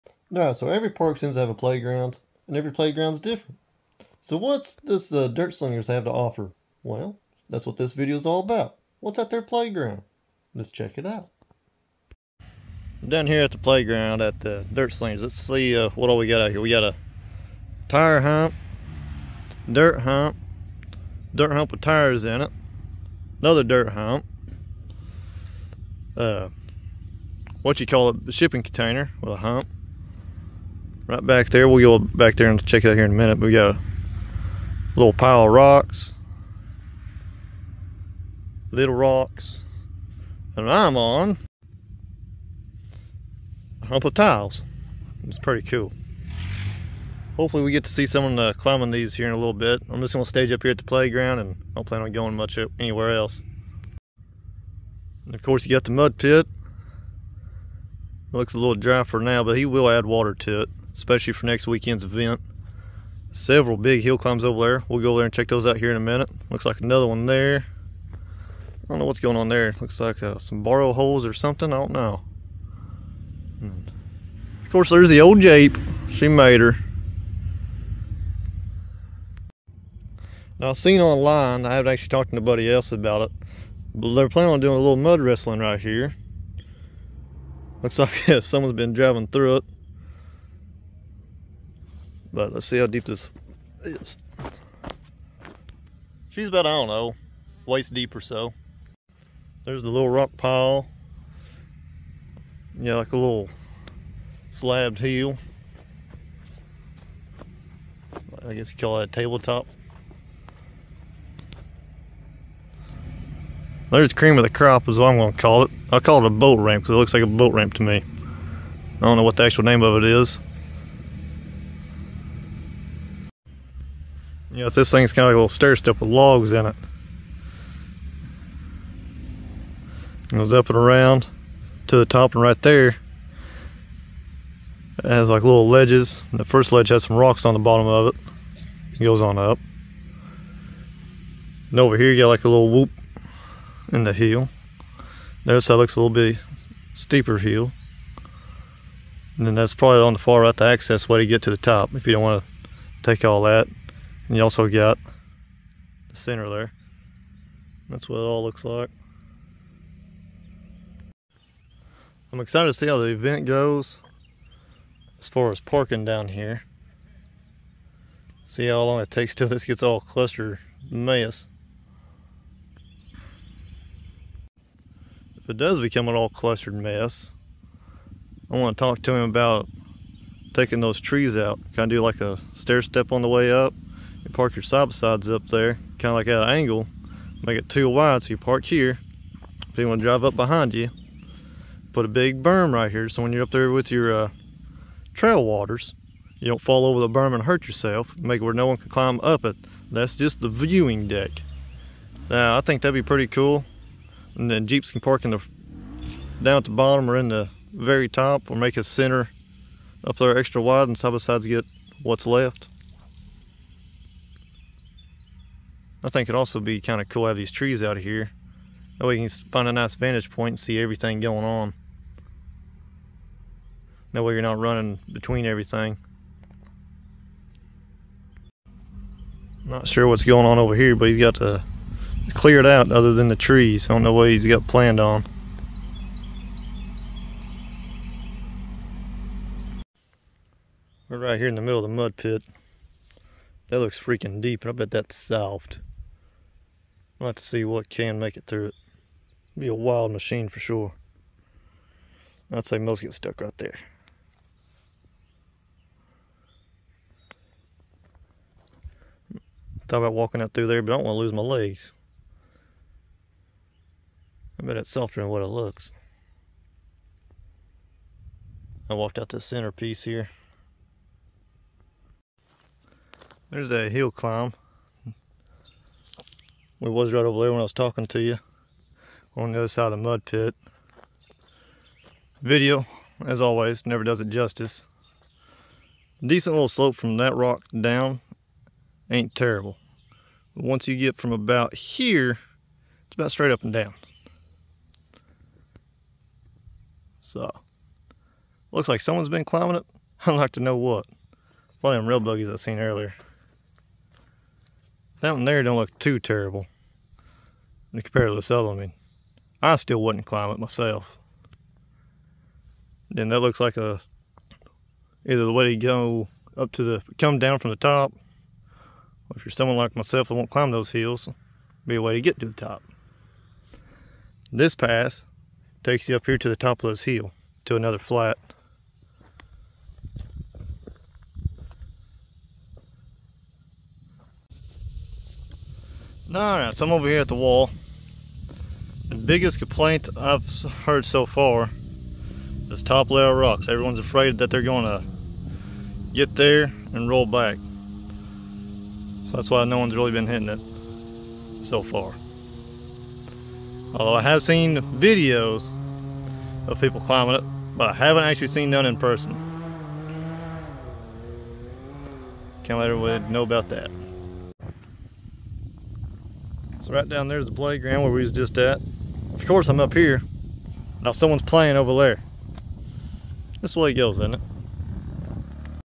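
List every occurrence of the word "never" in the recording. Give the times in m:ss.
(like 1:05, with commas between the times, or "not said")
4:43.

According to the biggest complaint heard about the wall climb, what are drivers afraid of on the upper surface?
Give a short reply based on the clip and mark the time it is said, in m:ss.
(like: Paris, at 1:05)
Top layer rocks, at 5:42.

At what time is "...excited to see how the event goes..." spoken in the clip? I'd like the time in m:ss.
2:42.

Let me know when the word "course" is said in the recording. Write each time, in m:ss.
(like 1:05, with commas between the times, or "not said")
0:55, 1:14, 6:09.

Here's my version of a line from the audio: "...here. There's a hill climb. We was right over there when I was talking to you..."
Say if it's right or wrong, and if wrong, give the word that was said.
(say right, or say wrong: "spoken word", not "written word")
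right.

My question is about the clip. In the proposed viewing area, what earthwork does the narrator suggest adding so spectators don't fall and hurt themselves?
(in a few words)
A big berm.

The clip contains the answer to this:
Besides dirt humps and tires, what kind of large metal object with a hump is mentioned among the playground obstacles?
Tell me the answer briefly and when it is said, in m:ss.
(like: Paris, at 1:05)
Shipping container, at 0:28.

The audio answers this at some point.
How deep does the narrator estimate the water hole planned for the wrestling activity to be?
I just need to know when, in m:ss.
1:37.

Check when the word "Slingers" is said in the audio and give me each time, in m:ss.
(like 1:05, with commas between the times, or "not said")
0:05, 0:14.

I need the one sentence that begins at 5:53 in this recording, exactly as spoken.
Although I have seen videos of people climbing it, but I haven't actually seen none in person.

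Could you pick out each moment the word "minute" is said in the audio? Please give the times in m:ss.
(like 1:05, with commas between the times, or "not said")
0:33, 1:06.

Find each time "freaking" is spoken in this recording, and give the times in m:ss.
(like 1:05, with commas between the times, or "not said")
4:04.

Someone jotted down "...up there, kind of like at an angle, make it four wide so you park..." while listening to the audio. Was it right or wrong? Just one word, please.
wrong.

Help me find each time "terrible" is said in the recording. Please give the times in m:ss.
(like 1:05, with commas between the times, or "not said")
4:49, 5:06.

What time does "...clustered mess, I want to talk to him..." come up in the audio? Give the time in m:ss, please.
2:56.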